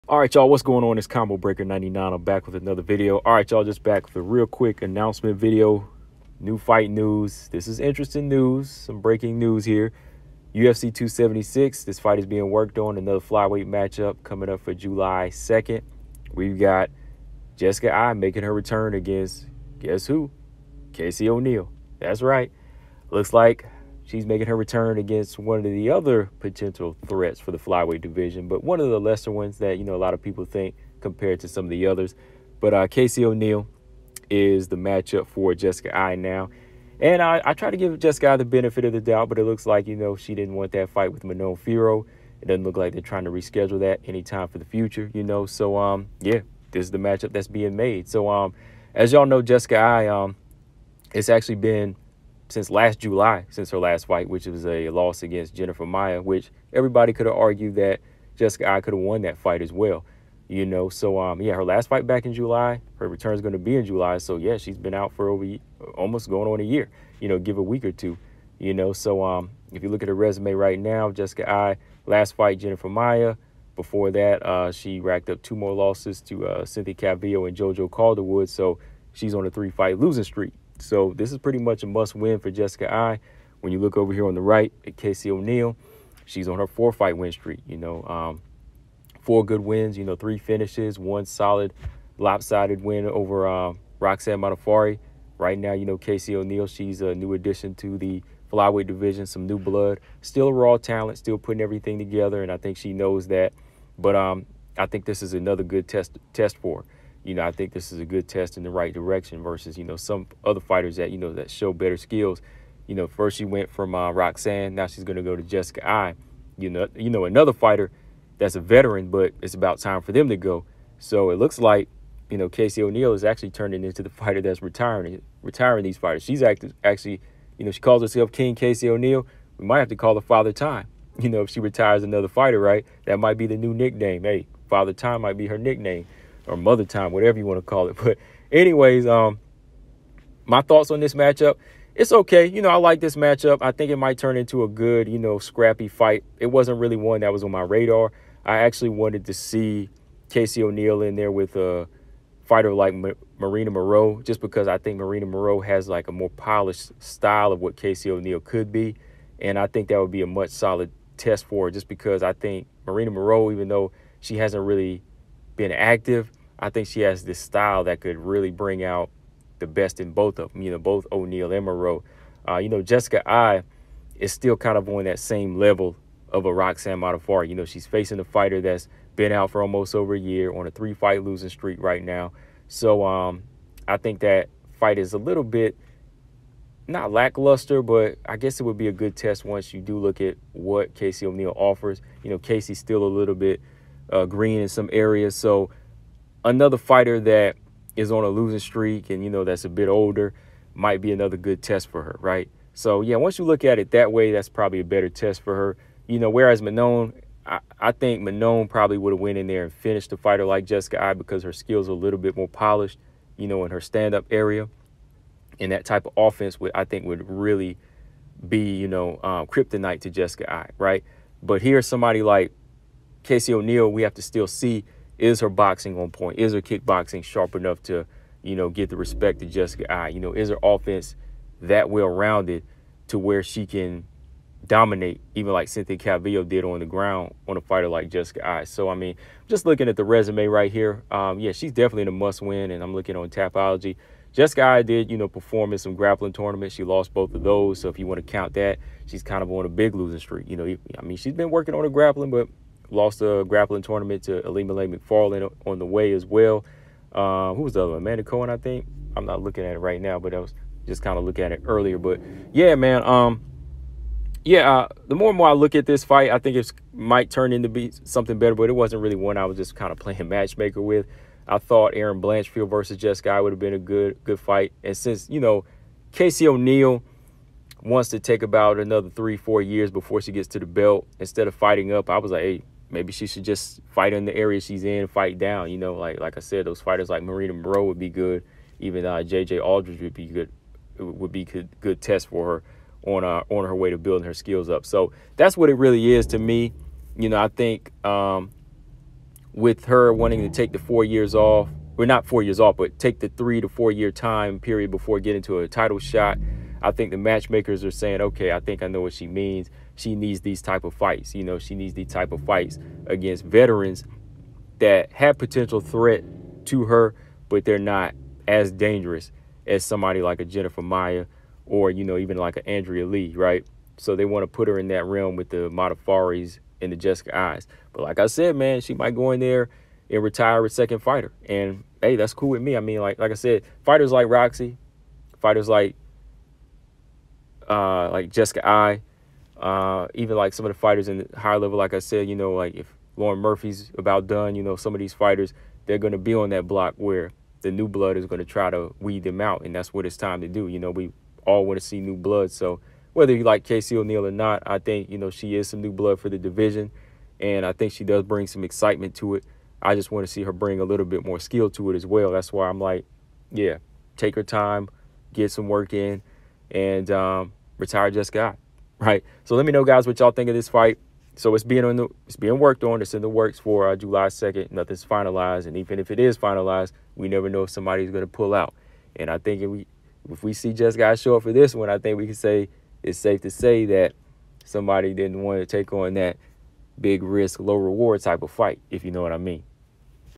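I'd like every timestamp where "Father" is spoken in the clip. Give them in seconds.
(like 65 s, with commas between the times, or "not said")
130 s, 134 s.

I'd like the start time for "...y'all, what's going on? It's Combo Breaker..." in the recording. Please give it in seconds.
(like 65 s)
0 s.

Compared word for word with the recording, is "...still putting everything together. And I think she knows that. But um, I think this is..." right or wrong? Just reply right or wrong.
right.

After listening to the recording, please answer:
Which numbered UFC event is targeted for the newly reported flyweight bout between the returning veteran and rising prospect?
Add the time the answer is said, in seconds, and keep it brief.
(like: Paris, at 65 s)
UFC 276, at 10 s.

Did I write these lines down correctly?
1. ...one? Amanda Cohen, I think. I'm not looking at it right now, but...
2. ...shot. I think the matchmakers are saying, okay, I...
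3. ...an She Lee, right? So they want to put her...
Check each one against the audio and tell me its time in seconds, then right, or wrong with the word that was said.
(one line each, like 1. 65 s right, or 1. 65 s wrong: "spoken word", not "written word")
1. 257 s right
2. 305 s right
3. 322 s wrong: "Andrea", not "She".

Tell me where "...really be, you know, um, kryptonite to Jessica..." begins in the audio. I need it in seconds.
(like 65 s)
217 s.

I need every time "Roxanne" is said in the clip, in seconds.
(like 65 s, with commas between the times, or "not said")
93 s, 114 s, 176 s.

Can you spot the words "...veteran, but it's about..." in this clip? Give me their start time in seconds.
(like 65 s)
118 s.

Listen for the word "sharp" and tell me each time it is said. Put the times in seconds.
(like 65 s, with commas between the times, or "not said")
227 s.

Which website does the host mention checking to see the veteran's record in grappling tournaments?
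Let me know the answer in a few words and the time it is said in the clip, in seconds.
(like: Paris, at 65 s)
Tapology, at 243 s.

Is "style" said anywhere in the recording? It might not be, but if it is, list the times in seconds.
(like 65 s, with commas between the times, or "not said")
157 s, 167 s.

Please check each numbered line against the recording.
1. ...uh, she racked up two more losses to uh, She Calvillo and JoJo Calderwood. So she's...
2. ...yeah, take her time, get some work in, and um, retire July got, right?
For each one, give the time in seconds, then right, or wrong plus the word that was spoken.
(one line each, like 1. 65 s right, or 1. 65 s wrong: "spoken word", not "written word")
1. 74 s wrong: "Cynthia", not "She"
2. 363 s wrong: "Just", not "July".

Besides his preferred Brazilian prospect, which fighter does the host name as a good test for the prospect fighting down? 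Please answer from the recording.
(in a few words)
J.J. Aldridge.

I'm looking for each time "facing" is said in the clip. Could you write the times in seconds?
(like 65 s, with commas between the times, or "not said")
177 s.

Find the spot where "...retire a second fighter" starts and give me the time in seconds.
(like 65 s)
330 s.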